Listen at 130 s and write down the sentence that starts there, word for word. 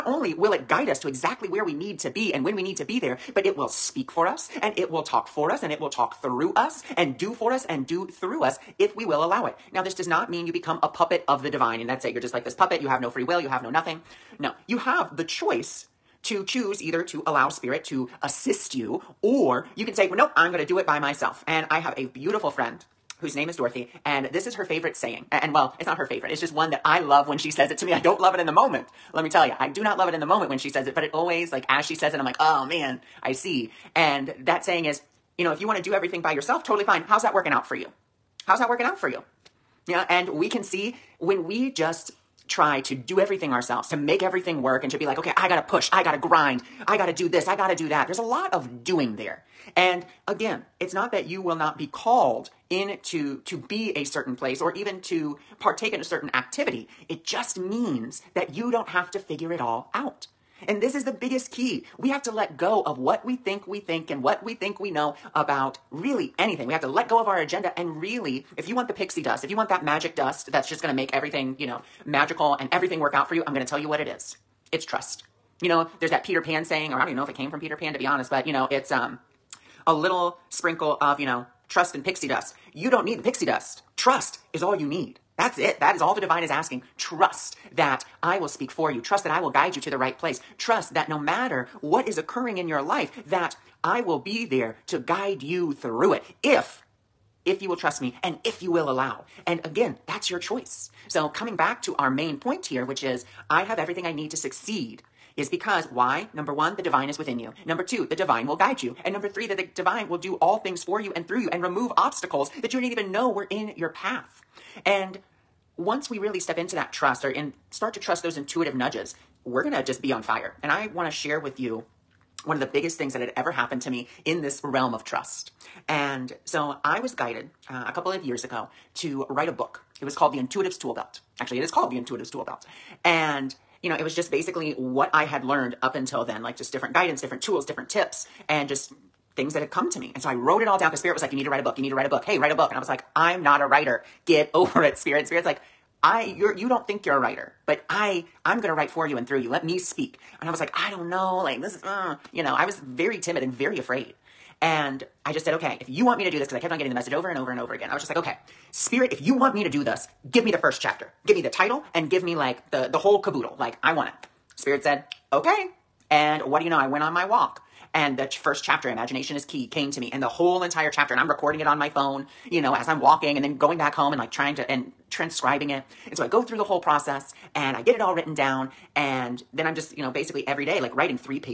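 It was called The Intuitive's Tool Belt.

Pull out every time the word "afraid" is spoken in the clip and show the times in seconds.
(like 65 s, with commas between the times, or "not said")
153 s.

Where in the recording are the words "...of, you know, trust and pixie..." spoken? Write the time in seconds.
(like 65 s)
80 s.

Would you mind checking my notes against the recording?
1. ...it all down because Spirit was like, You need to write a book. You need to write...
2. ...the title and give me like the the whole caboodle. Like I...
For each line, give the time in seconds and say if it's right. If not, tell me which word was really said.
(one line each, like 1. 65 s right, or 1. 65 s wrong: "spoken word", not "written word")
1. 140 s right
2. 161 s right.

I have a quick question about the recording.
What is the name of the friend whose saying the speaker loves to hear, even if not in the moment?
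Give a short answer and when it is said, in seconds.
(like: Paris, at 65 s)
Dorothy, at 23 s.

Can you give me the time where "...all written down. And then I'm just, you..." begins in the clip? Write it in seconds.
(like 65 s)
178 s.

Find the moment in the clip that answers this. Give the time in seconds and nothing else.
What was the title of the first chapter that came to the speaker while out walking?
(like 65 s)
168 s.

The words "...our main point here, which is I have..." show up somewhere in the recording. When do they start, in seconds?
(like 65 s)
101 s.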